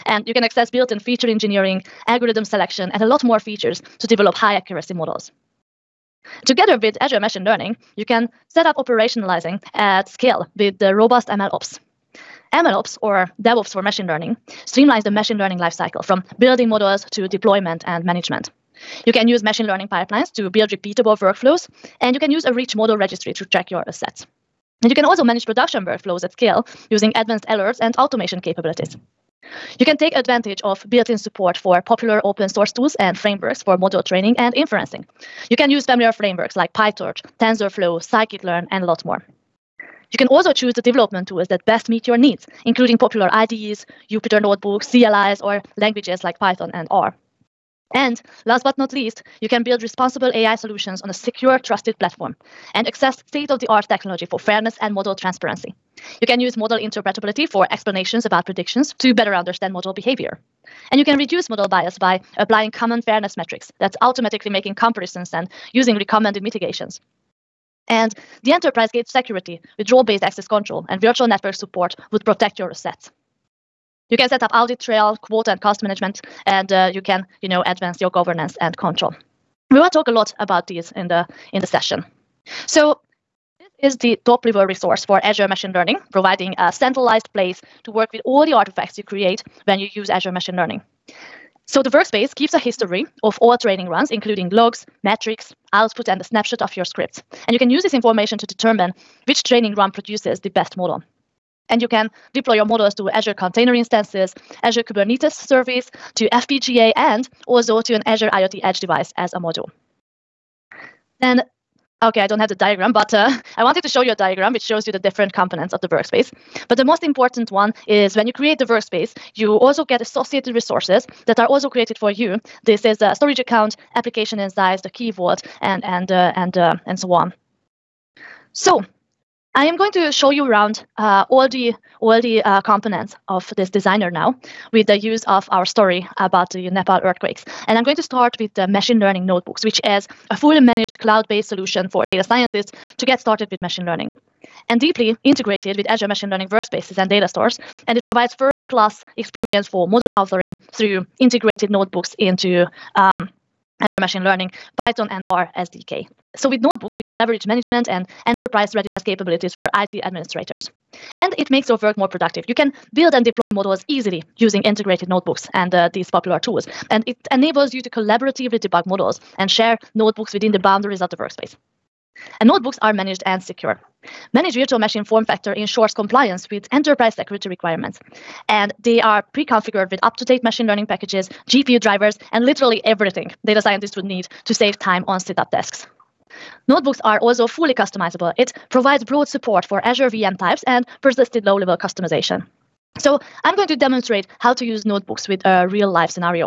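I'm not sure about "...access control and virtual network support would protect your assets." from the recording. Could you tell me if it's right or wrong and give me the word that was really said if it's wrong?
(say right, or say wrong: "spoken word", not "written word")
right.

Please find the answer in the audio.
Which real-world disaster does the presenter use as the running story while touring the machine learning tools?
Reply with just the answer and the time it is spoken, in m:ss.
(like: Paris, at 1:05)
Nepal earthquakes, at 2:16.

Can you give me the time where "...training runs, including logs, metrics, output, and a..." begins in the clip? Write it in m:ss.
1:33.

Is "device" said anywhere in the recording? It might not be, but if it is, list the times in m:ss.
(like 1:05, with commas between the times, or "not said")
1:48.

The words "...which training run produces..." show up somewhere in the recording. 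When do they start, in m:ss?
1:39.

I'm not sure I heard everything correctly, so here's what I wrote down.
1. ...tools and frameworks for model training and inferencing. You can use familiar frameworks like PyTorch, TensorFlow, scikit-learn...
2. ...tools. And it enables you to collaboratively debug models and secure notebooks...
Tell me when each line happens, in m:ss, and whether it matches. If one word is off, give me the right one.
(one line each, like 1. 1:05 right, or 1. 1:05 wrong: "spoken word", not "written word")
1. 0:32 right
2. 2:46 wrong: "share", not "secure".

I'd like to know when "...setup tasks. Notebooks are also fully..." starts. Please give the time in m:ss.
3:05.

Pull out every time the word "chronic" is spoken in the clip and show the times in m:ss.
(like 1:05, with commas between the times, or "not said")
not said.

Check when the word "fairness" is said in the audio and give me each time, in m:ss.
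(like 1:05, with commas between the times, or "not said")
0:54, 1:03.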